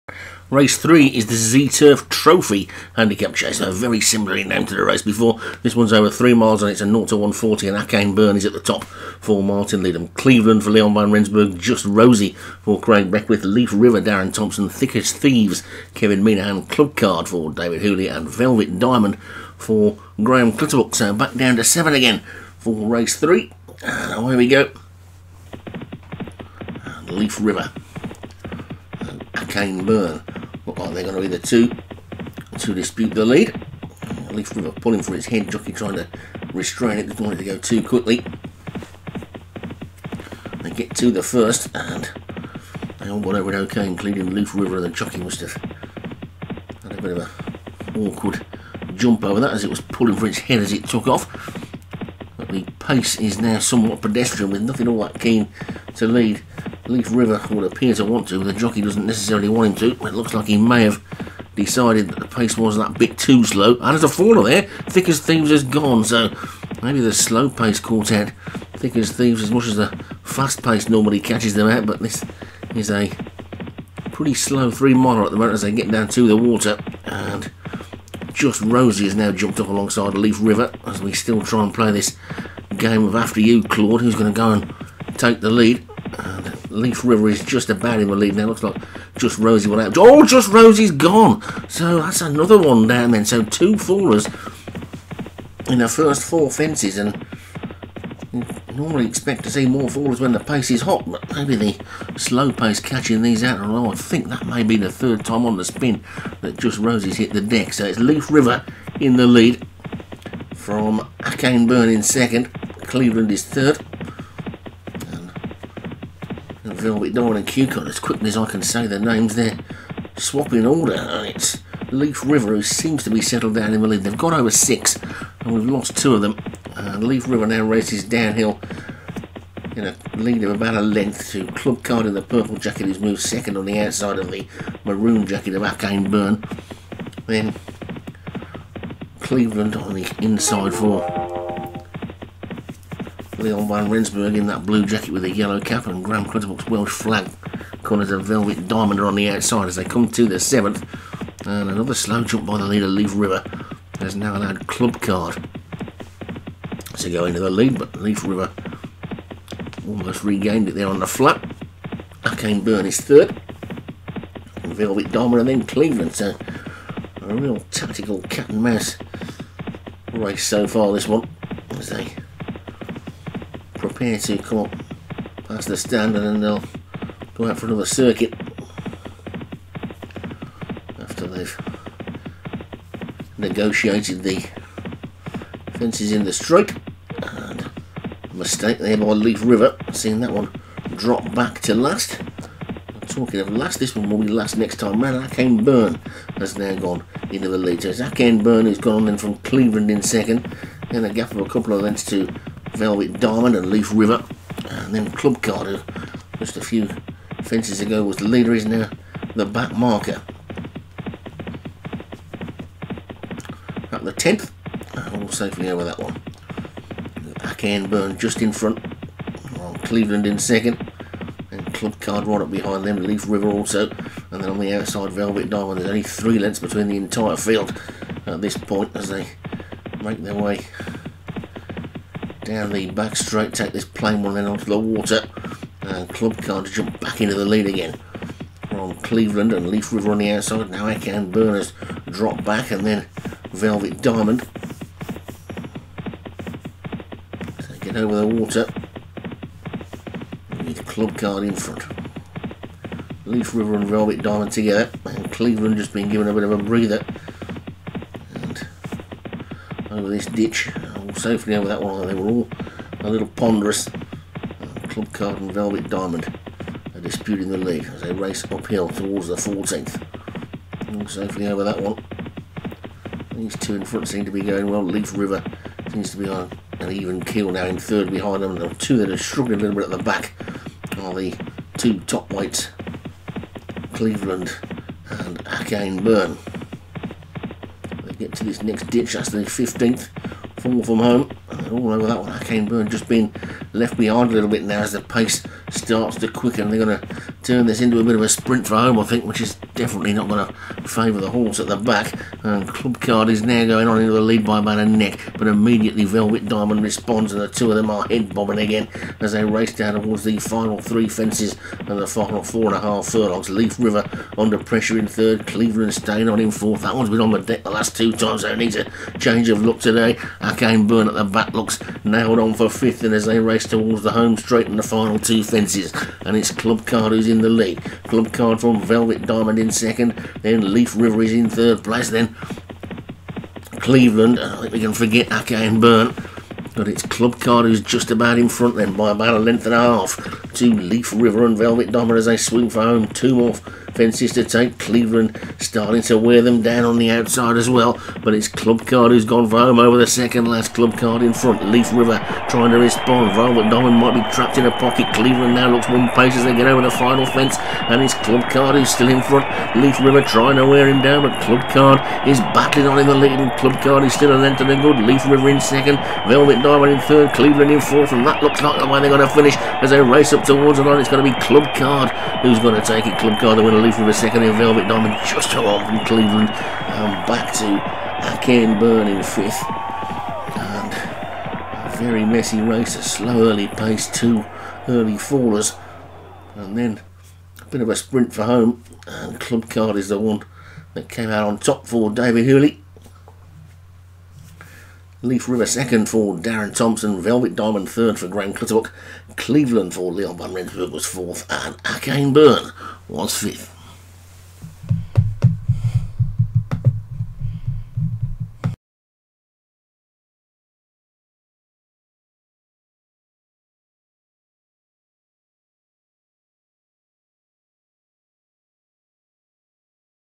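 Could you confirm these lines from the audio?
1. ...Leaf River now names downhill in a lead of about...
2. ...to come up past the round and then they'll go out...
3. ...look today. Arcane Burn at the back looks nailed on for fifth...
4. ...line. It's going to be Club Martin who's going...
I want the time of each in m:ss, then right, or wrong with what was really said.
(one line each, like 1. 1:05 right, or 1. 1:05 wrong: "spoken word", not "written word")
1. 2:06 wrong: "races", not "names"
2. 2:54 wrong: "stand", not "round"
3. 5:19 right
4. 6:10 wrong: "Card", not "Martin".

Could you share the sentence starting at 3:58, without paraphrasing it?
From Cleveland and Leaf River on the outside, now Akan Burners drop back and then Velvet Diamond.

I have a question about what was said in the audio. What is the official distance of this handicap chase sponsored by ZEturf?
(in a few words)
3 miles.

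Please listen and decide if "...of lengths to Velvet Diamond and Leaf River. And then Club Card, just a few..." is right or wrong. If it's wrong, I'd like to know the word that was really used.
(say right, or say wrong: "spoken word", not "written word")
right.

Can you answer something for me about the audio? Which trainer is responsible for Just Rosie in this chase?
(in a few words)
Craig Beckwith.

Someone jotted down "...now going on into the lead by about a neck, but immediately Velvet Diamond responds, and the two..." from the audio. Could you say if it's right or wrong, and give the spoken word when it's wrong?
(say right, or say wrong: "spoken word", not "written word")
right.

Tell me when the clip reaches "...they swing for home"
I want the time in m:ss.
5:42.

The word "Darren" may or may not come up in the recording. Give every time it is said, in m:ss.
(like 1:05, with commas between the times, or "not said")
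0:14, 6:36.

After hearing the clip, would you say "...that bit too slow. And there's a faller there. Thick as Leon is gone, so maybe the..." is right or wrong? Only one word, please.
wrong.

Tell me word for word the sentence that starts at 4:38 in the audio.
The two that are struggling a little bit at the back are the two top weights, Cleveland and Akane Burn.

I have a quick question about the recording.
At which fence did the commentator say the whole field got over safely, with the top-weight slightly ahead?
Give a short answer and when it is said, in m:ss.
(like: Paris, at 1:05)
10th, at 3:34.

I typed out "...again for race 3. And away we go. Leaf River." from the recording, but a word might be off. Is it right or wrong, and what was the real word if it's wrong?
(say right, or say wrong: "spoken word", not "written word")
right.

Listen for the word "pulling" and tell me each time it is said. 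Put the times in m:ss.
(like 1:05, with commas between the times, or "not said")
0:34, 0:49.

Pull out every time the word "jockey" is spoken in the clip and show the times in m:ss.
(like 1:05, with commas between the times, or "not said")
0:35, 0:44, 0:58.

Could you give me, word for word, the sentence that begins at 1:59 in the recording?
They're swapping order and it's Leaf River who seems to be settled down in the lead.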